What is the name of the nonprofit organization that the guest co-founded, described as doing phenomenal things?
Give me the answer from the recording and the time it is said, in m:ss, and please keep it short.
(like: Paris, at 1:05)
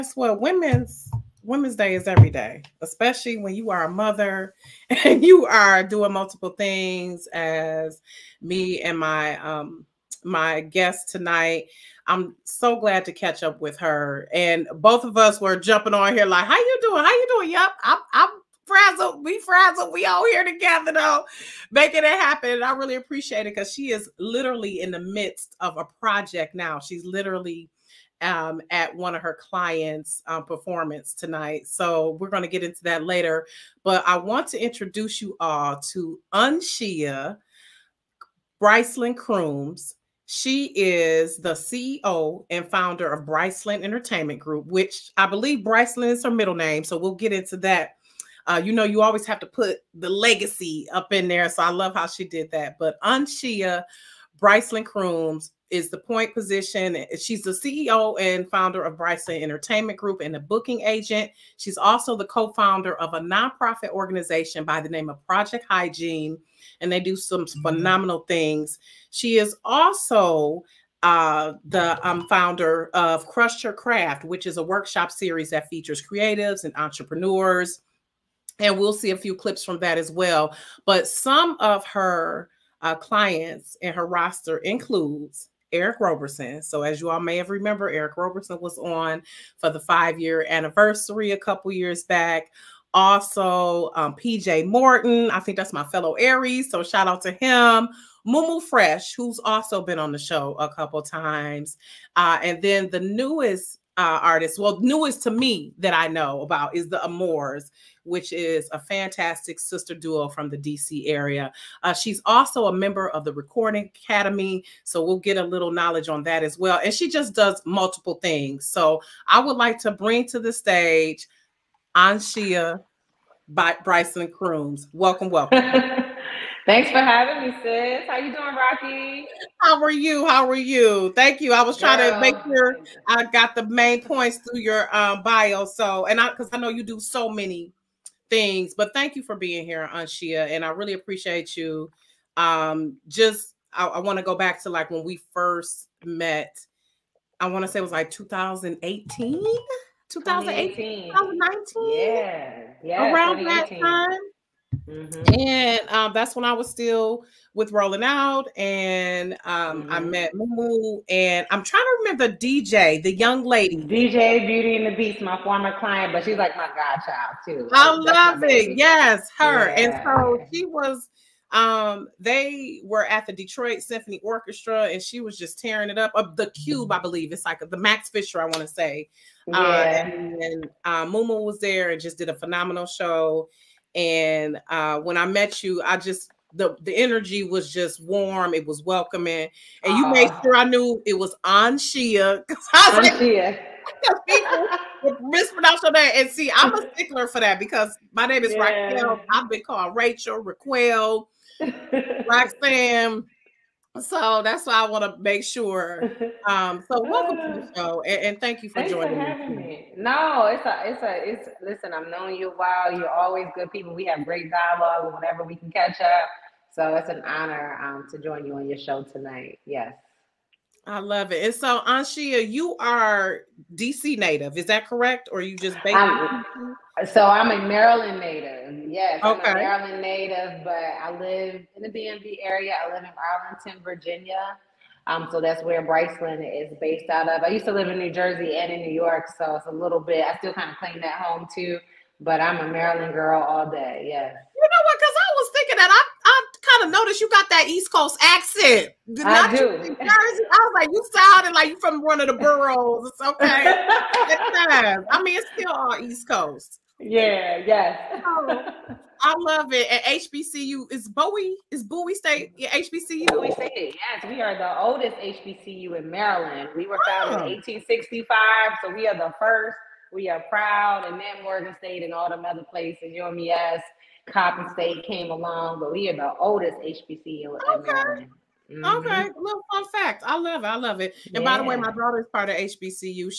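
Project Hygiene, at 1:05.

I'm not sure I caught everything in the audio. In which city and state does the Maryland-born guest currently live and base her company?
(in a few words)
Arlington, Virginia.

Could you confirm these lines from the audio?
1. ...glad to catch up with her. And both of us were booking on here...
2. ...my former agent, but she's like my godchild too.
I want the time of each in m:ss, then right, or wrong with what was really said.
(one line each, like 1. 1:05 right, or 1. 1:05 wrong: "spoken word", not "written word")
1. 0:12 wrong: "jumping", not "booking"
2. 2:45 wrong: "client", not "agent".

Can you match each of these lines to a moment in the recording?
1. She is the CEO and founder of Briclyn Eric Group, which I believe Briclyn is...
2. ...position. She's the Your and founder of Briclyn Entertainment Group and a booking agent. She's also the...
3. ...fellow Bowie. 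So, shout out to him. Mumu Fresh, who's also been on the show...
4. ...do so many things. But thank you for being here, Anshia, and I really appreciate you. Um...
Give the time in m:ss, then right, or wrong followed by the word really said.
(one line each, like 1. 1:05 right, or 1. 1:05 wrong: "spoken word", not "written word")
1. 0:40 wrong: "Entertainment", not "Eric"
2. 0:56 wrong: "CEO", not "Your"
3. 1:35 wrong: "Aries", not "Bowie"
4. 2:16 right.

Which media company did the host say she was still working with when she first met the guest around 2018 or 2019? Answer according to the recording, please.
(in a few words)
Rolling Out.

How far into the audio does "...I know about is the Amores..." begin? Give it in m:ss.
1:45.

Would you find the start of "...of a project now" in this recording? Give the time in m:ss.
0:25.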